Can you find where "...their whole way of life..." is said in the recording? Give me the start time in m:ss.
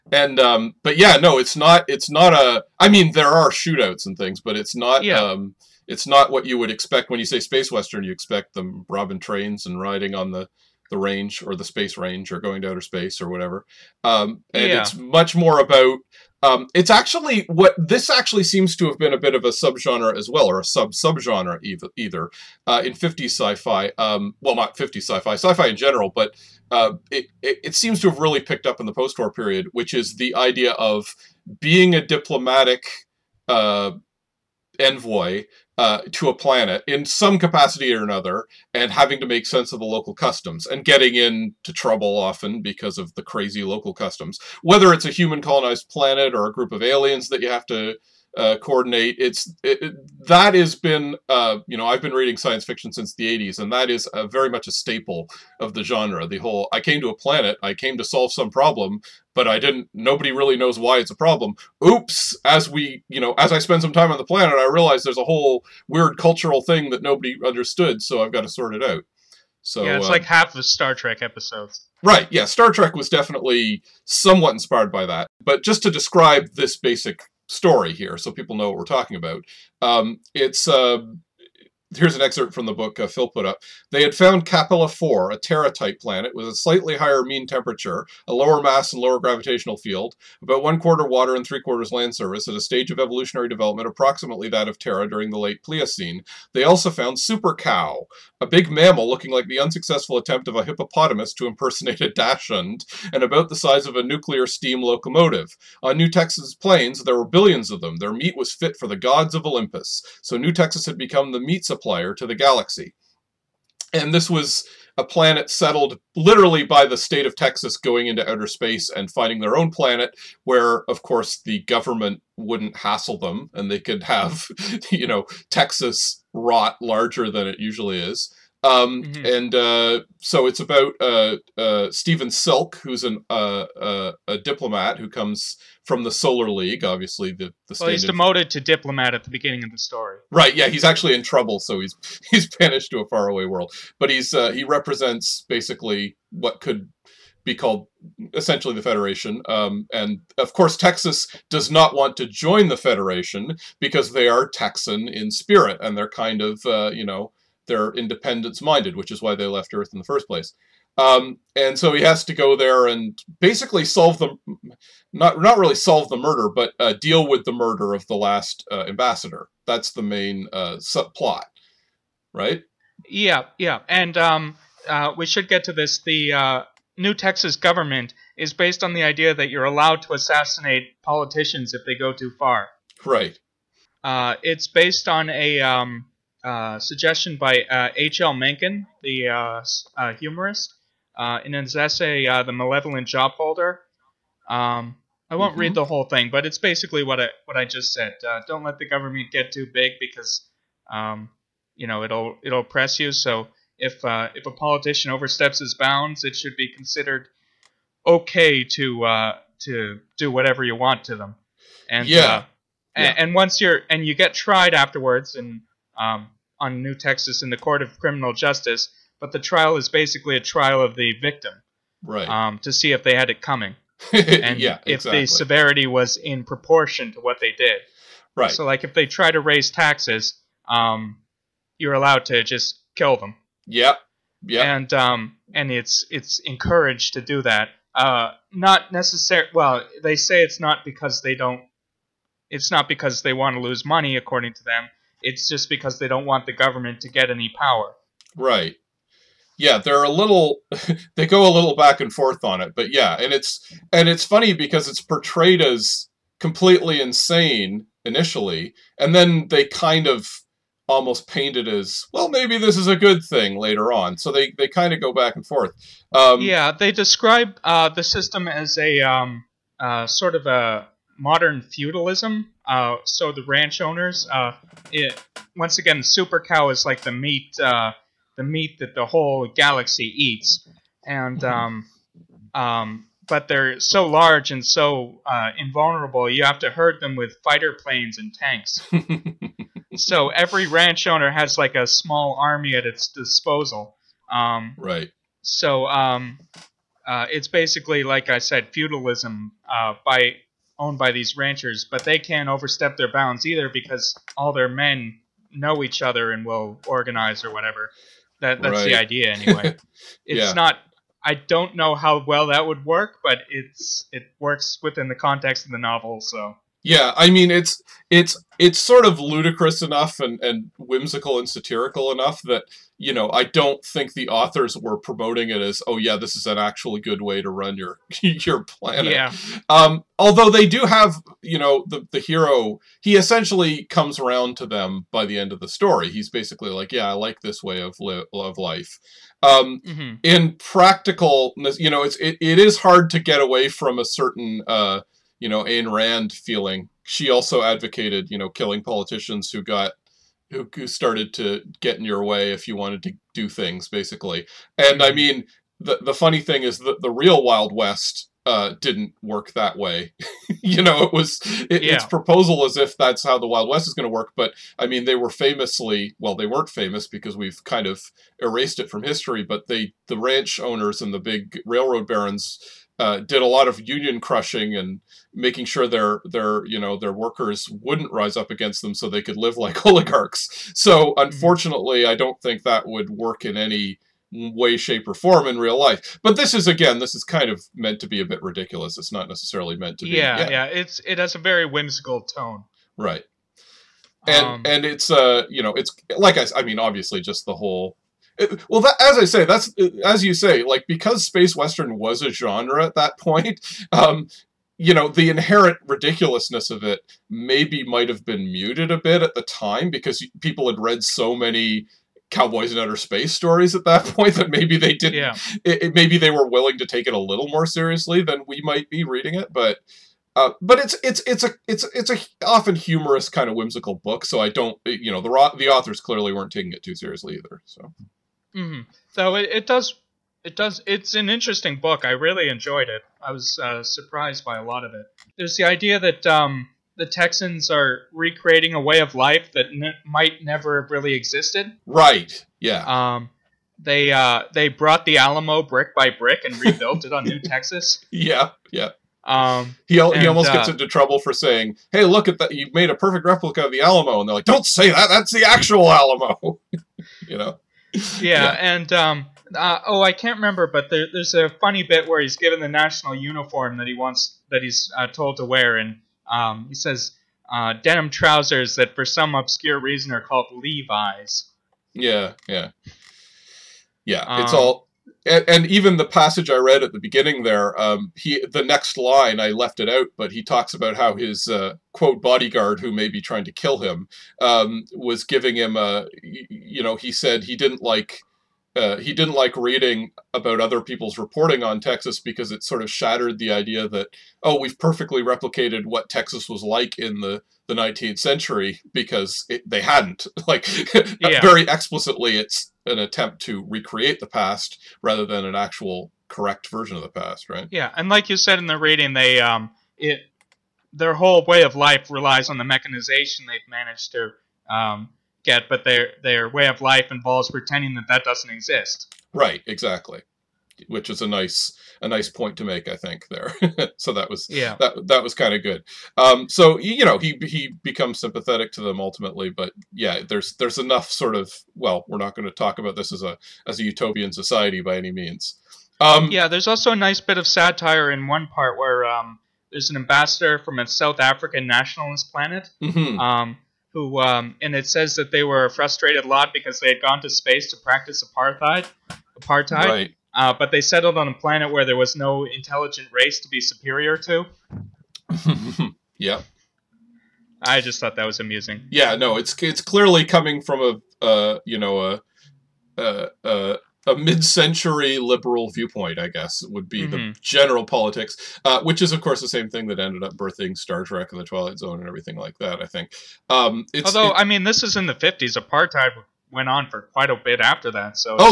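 8:30.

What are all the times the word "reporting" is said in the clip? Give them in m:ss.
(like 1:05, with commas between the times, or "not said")
8:11.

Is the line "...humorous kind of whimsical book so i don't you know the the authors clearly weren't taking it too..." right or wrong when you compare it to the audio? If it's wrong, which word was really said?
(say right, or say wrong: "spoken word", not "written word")
right.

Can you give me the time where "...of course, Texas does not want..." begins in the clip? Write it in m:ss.
2:30.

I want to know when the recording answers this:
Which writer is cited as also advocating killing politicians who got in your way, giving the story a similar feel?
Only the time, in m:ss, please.
5:45.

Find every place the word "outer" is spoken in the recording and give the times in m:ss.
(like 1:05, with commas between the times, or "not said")
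0:12, 1:58, 6:52.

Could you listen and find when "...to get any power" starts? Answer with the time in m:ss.
4:07.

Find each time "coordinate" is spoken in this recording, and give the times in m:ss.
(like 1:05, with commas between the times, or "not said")
0:48.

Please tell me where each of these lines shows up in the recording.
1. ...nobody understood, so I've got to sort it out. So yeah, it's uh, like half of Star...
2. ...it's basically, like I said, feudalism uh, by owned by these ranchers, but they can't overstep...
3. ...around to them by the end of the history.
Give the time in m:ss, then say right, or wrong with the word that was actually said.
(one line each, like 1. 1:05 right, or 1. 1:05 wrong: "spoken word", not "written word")
1. 1:07 right
2. 4:57 right
3. 5:34 wrong: "story", not "history".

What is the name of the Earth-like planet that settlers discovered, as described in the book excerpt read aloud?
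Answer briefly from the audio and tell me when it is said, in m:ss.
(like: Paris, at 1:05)
Capella 4, at 1:24.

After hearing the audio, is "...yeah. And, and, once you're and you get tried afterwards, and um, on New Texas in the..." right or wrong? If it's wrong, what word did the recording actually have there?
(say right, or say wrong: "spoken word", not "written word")
right.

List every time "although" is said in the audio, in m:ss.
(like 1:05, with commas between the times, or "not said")
5:30, 9:34.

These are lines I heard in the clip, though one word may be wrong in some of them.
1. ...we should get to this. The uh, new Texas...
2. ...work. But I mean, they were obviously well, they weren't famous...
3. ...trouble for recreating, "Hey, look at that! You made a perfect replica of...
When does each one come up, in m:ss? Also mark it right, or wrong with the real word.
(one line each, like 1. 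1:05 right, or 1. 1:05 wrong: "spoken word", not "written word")
1. 2:55 right
2. 6:04 wrong: "famously", not "obviously"
3. 7:30 wrong: "saying", not "recreating".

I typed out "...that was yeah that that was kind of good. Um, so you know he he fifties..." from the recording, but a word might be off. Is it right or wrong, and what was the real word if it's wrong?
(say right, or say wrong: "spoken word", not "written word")
wrong: "becomes", not "fifties".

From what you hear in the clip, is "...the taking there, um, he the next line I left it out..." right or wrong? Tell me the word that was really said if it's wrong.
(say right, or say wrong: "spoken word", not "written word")
wrong: "beginning", not "taking".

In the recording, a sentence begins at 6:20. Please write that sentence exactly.
So unfortunately, I don't think that would work in any way, shape, or form in real life.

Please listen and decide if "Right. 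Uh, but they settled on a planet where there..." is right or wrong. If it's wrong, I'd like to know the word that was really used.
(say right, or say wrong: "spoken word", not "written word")
right.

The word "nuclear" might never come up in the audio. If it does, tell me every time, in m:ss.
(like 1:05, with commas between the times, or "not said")
1:44.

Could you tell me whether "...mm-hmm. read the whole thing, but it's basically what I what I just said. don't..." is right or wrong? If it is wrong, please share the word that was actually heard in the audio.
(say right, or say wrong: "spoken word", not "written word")
right.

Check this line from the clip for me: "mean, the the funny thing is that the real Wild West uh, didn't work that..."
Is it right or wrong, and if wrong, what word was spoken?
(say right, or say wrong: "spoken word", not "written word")
right.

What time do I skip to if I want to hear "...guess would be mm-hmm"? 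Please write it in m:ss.
9:26.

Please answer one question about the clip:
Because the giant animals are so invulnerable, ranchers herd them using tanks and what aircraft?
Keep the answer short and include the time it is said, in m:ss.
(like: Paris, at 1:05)
Fighter planes, at 4:47.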